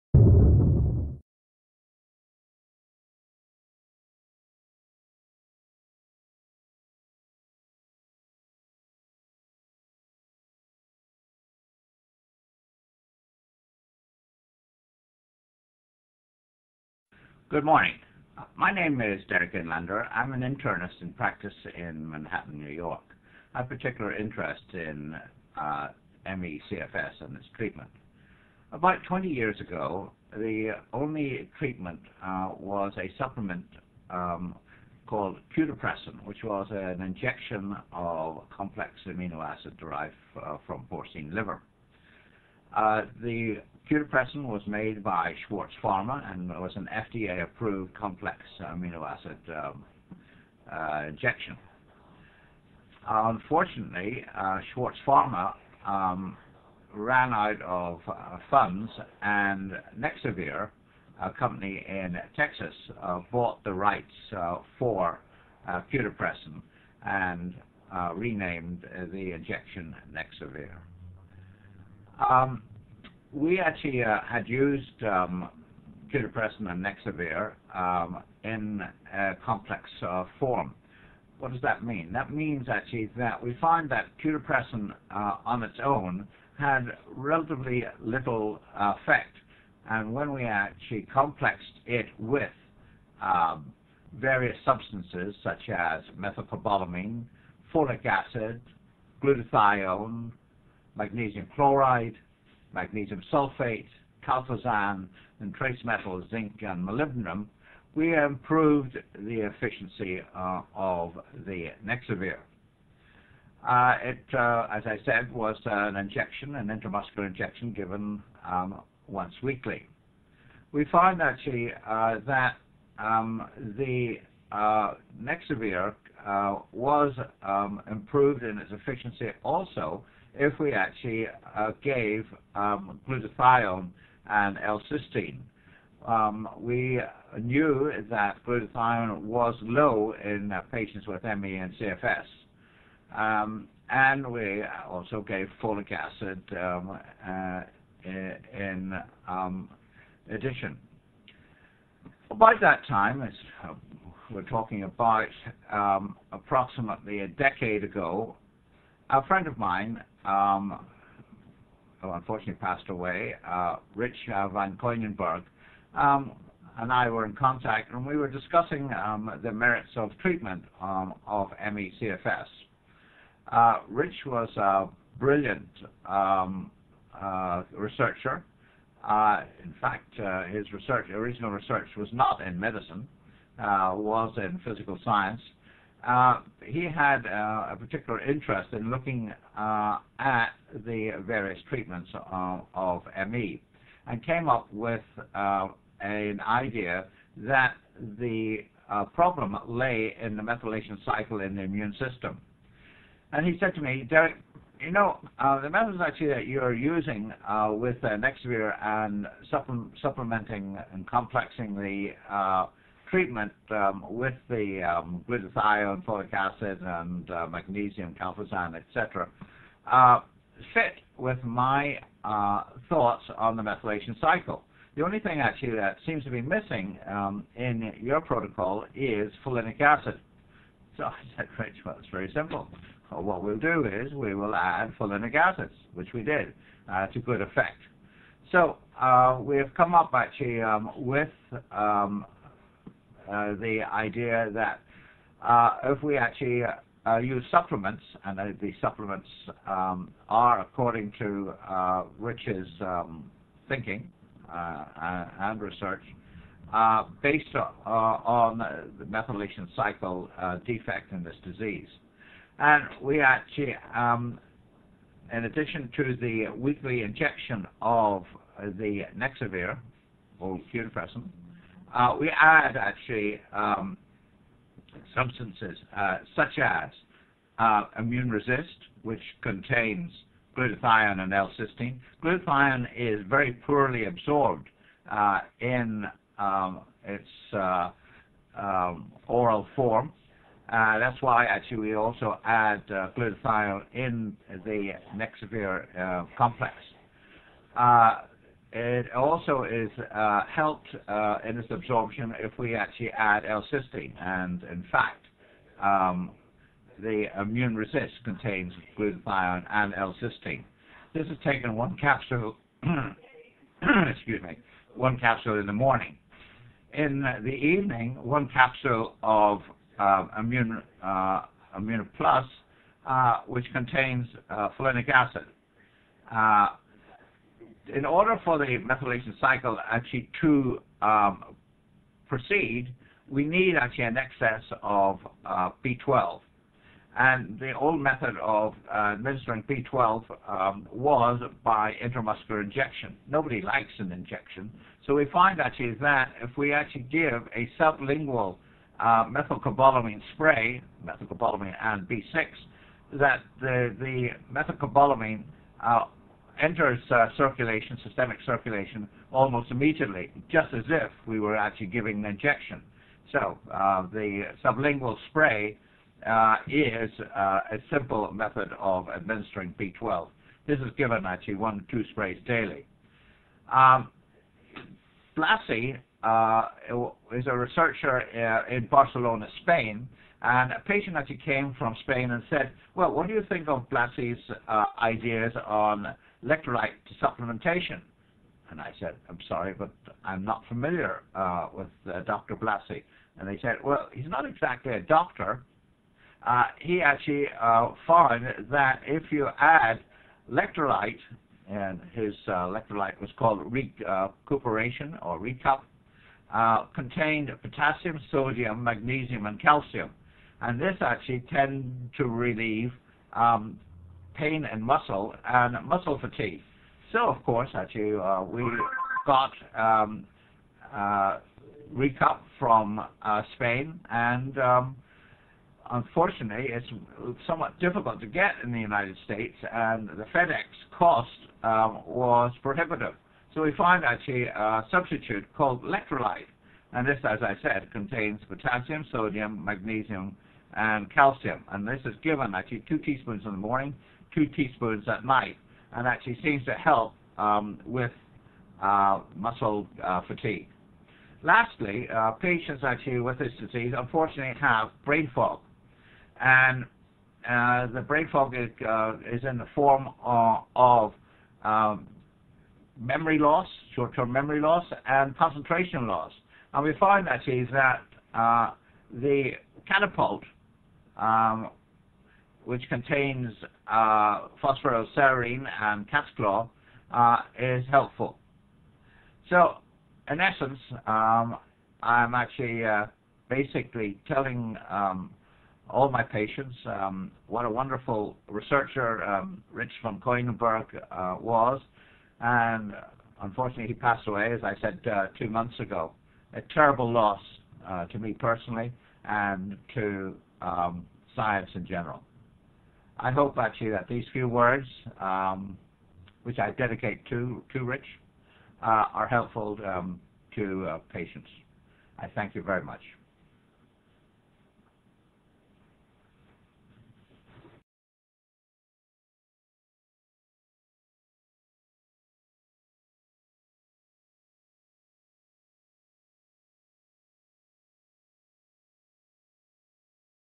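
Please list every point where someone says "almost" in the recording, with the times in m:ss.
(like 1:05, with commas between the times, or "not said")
5:59.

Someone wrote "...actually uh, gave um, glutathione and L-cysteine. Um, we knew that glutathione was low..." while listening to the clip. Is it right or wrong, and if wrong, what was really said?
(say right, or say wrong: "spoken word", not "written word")
right.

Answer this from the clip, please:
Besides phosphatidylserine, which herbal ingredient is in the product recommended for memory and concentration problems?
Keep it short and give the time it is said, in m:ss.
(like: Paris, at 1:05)
Cat's claw, at 7:56.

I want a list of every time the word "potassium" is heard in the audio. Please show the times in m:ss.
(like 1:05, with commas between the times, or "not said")
6:47, 7:18.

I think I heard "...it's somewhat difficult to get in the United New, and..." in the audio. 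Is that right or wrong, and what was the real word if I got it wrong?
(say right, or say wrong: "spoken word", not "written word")
wrong: "States", not "New".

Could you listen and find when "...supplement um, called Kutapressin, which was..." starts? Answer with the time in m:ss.
0:33.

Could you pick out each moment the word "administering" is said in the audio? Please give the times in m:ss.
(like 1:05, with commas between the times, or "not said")
5:39, 6:09.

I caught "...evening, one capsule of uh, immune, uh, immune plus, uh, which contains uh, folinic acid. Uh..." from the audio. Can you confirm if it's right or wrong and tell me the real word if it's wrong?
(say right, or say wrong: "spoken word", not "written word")
right.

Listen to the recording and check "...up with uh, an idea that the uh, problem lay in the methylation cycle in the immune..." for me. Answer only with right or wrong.
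right.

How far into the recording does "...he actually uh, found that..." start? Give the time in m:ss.
6:36.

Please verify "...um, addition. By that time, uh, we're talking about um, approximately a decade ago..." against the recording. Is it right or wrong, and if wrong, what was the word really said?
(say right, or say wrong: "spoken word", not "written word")
right.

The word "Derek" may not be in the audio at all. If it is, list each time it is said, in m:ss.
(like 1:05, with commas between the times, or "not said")
0:19, 3:24.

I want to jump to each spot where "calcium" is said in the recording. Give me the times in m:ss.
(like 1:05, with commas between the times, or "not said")
6:49, 7:21.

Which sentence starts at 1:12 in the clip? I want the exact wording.
Um, we actually uh, had used um, and Nexavir um, in a complex uh, form.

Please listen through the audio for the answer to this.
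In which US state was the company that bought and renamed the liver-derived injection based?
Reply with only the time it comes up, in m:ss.
1:02.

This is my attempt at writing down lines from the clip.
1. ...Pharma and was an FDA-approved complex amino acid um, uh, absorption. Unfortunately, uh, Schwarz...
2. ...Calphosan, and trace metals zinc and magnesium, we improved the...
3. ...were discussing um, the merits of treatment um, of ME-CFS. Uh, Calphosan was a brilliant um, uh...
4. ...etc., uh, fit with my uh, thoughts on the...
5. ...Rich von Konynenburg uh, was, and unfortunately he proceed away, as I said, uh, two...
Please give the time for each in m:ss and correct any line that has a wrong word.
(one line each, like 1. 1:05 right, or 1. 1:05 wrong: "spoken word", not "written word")
1. 0:45 wrong: "injection", not "absorption"
2. 1:44 wrong: "molybdenum", not "magnesium"
3. 2:48 wrong: "Rich", not "Calphosan"
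4. 3:38 right
5. 8:09 wrong: "passed", not "proceed".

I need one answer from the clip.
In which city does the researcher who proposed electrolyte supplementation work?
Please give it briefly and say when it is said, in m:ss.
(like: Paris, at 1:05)
Barcelona, at 6:18.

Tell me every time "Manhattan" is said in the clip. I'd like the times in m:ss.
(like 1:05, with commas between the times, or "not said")
0:22.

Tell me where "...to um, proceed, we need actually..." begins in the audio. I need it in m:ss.
5:30.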